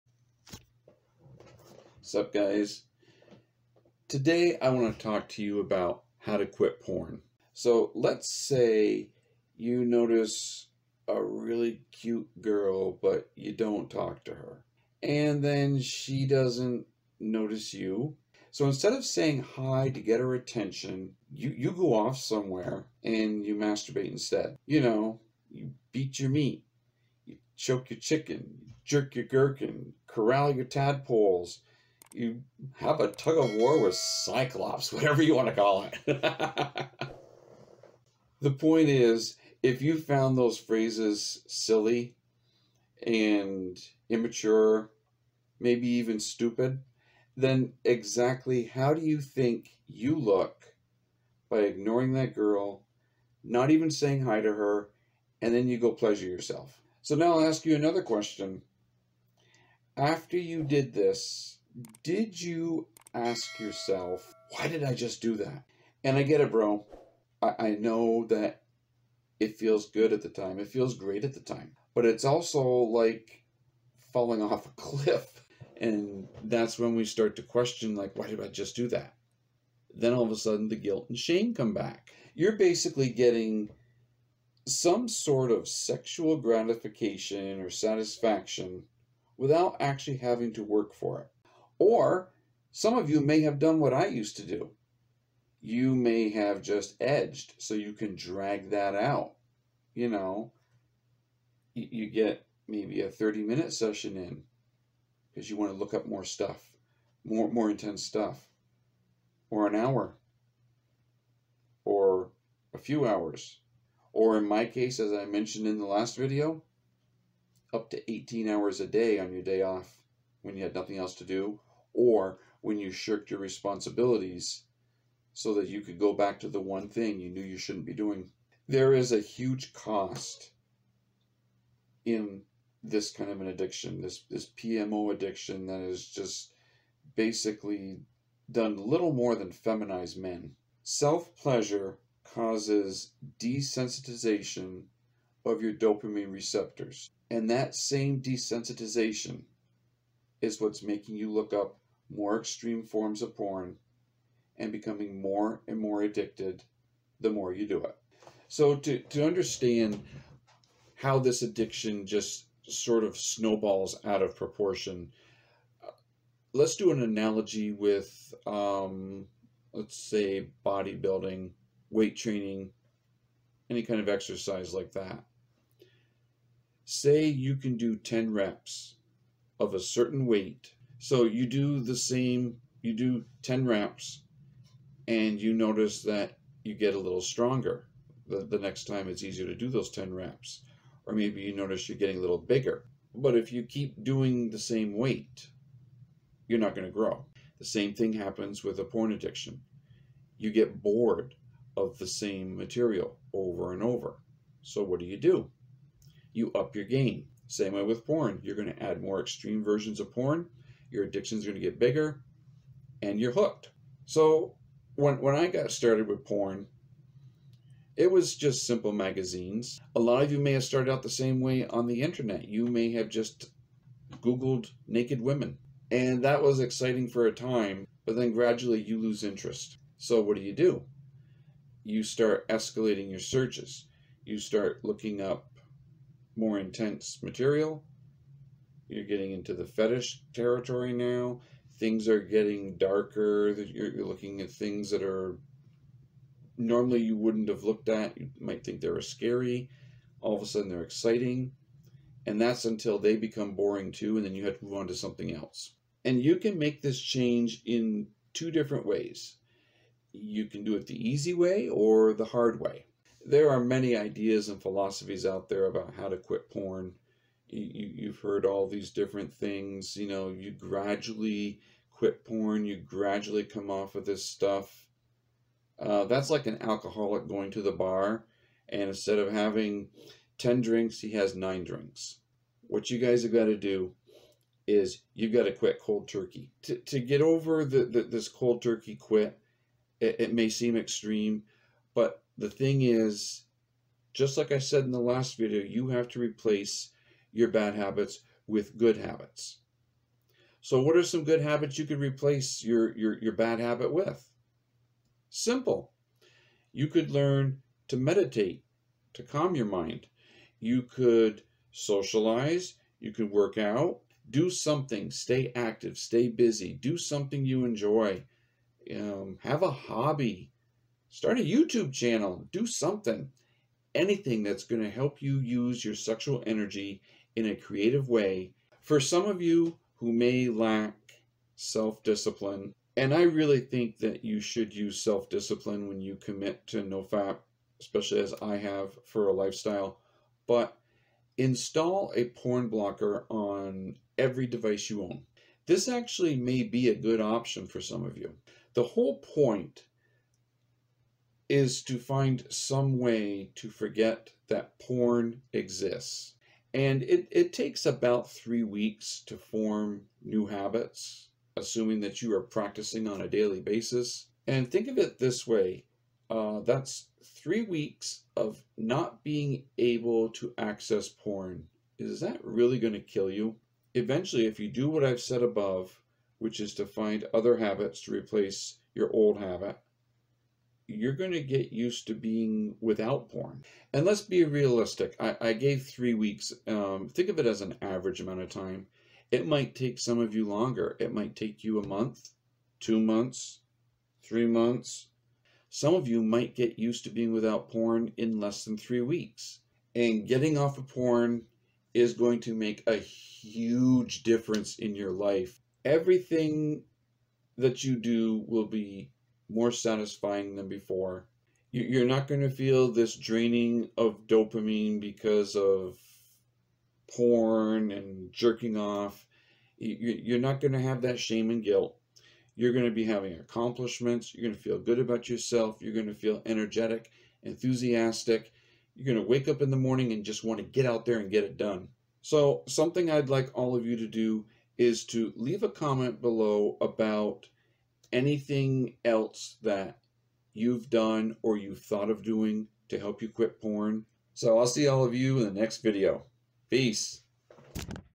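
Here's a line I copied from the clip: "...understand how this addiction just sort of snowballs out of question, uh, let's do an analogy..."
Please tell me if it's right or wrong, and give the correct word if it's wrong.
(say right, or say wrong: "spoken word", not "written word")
wrong: "proportion", not "question".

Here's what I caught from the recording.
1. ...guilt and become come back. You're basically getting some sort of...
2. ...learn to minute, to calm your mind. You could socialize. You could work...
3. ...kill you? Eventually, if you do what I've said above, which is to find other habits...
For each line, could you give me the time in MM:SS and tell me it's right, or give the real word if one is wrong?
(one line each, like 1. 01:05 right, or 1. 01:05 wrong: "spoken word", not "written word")
1. 01:20 wrong: "shame", not "become"
2. 05:07 wrong: "meditate", not "minute"
3. 06:13 right.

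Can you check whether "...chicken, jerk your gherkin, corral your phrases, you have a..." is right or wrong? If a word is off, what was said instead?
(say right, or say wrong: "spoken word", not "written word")
wrong: "tadpoles", not "phrases".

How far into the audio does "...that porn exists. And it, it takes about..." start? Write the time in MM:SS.
05:54.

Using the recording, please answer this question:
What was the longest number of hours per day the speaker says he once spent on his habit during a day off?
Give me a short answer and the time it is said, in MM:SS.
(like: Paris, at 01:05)
18 hours, at 01:58.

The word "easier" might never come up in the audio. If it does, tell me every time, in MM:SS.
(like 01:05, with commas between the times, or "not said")
03:09.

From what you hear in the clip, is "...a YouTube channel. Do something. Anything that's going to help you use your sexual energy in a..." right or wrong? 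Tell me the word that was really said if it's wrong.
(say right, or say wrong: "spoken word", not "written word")
right.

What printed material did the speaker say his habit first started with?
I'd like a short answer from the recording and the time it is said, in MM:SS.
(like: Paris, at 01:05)
Magazines, at 03:38.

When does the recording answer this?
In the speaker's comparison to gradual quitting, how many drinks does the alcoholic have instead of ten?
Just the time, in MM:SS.
04:41.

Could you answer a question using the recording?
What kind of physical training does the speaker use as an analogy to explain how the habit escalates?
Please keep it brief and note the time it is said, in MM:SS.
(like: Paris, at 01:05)
Bodybuilding, at 02:50.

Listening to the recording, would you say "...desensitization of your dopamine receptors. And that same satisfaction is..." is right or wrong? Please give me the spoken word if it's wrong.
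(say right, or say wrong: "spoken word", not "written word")
wrong: "desensitization", not "satisfaction".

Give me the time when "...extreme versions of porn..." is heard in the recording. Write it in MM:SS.
03:29.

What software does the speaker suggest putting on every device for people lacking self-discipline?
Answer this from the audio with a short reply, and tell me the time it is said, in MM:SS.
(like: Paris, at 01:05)
Porn blocker, at 05:42.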